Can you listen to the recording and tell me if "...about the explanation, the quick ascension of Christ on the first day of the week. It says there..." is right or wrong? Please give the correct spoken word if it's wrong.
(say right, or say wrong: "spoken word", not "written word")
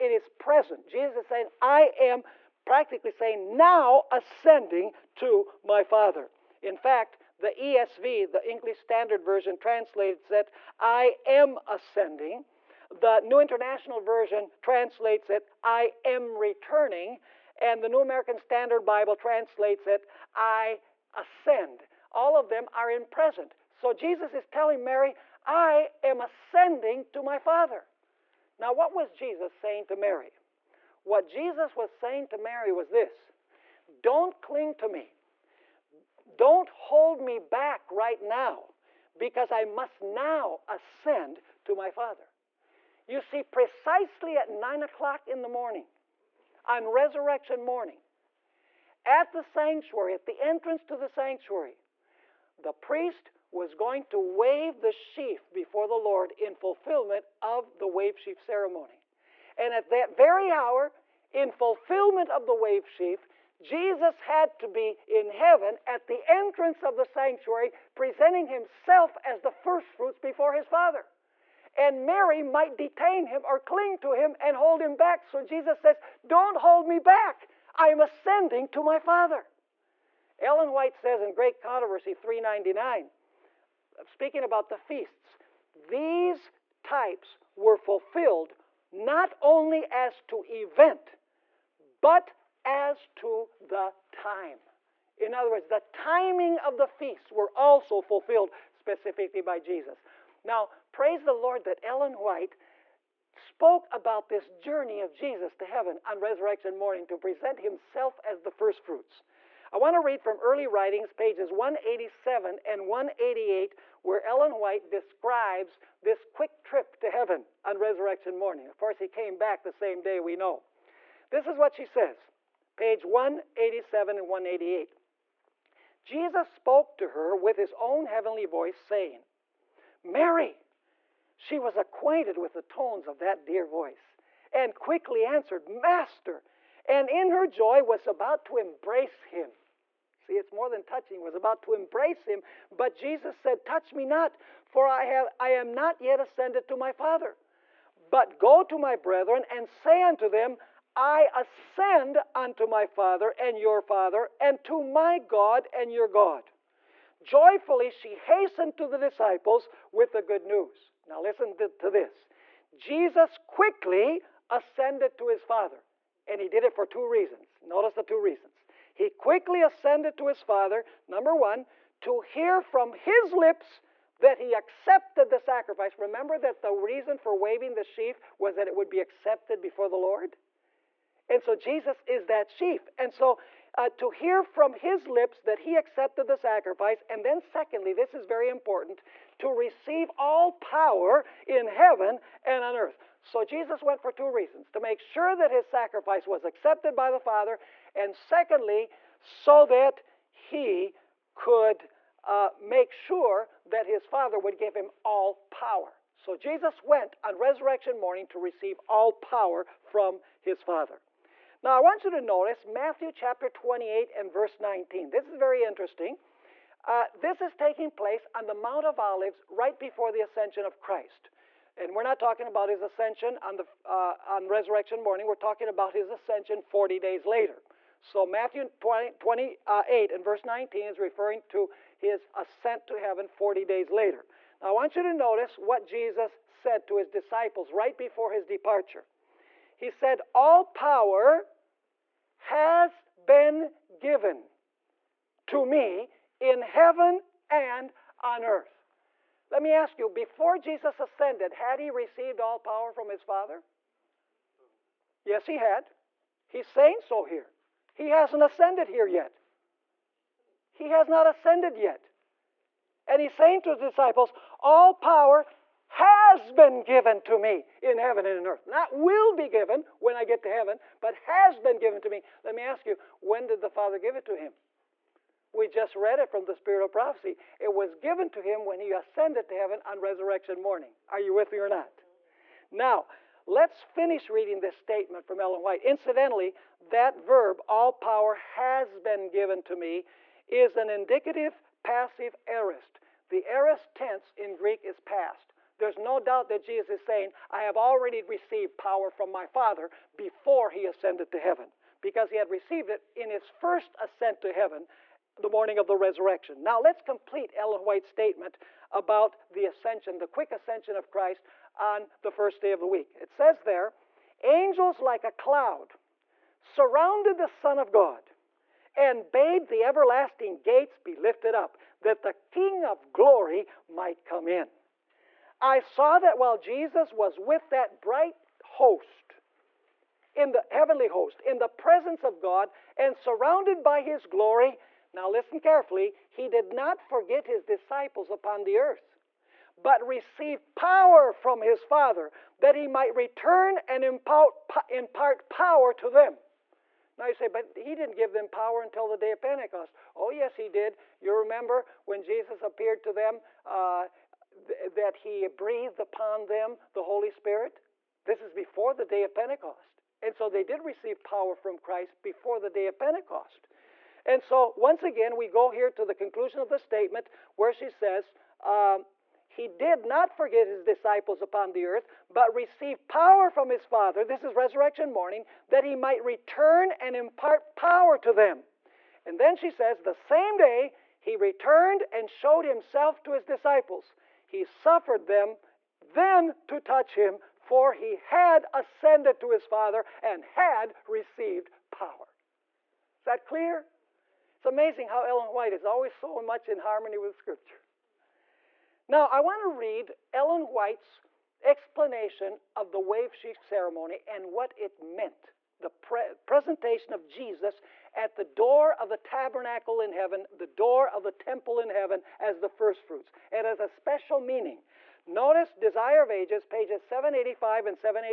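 wrong: "ascension", not "explanation".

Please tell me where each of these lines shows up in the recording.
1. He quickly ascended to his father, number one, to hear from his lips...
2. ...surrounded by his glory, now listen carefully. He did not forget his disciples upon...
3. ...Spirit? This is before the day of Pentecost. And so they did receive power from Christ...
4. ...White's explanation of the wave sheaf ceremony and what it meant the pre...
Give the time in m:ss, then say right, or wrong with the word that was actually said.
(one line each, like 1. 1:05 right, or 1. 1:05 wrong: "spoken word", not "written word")
1. 2:48 right
2. 5:33 right
3. 5:57 right
4. 6:40 right.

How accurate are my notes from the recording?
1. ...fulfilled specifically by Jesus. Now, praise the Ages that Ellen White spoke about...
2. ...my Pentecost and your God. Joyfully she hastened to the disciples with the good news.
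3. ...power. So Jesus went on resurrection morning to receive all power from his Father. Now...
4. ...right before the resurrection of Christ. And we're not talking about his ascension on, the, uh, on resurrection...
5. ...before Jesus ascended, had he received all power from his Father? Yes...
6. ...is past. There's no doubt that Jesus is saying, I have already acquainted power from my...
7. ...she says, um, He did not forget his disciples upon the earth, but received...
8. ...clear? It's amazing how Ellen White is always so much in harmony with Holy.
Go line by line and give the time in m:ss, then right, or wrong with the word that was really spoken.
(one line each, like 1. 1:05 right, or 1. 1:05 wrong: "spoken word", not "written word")
1. 1:37 wrong: "Lord", not "Ages"
2. 2:34 wrong: "God", not "Pentecost"
3. 3:25 right
4. 3:39 wrong: "ascension", not "resurrection"
5. 4:10 right
6. 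4:54 wrong: "received", not "acquainted"
7. 6:07 right
8. 6:33 wrong: "Scripture", not "Holy".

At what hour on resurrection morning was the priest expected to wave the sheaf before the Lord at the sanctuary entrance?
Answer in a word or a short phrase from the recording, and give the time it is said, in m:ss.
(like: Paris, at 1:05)
9 o'clock, at 0:44.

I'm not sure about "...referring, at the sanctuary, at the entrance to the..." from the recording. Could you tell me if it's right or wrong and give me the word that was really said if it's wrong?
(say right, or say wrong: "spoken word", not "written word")
wrong: "morning", not "referring".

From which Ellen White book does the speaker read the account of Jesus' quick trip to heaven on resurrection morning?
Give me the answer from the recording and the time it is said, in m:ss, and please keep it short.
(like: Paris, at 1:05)
Early Writings, at 1:50.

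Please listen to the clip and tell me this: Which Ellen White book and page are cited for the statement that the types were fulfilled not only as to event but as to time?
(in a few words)
Great Controversy 399.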